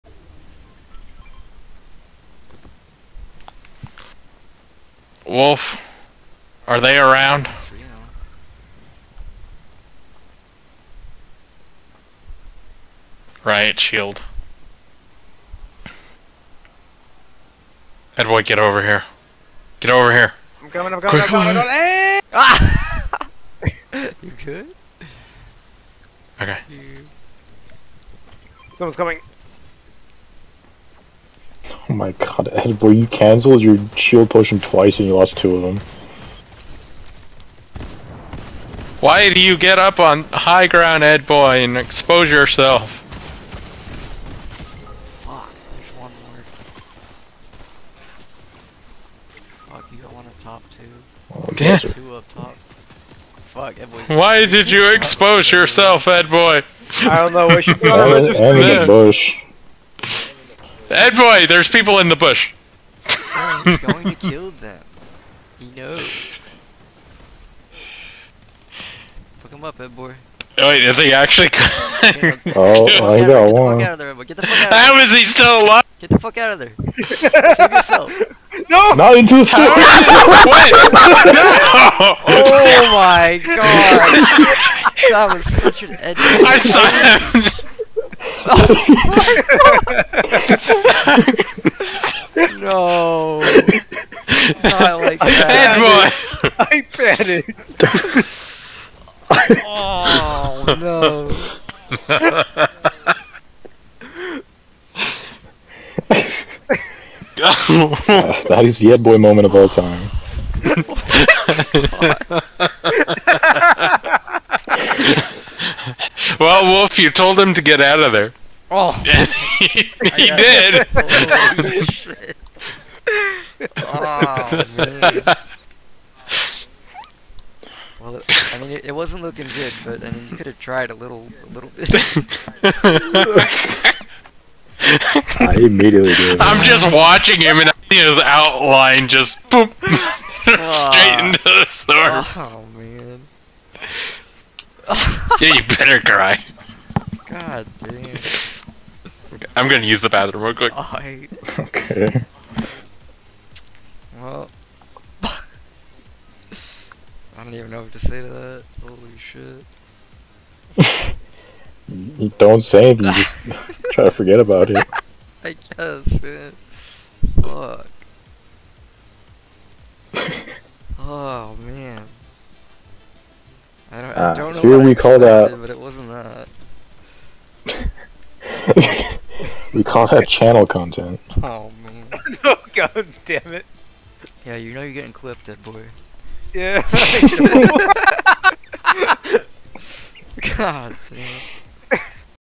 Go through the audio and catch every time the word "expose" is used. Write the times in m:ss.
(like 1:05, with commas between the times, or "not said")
0:41, 0:54.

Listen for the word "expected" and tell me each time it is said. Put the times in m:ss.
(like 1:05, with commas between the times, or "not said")
2:54.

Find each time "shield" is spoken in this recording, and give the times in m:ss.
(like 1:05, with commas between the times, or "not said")
0:13, 0:33.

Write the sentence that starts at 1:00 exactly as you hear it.
Ed boy, there's people in the bush.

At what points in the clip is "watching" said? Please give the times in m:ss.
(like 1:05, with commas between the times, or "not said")
2:16.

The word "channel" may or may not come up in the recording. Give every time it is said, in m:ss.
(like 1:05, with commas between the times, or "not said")
3:00.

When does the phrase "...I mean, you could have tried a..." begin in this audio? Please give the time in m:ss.
2:10.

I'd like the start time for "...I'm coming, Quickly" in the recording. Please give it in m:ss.
0:20.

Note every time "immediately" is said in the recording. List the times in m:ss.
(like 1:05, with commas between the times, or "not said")
2:15.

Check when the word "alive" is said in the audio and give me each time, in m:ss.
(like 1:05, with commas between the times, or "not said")
1:15.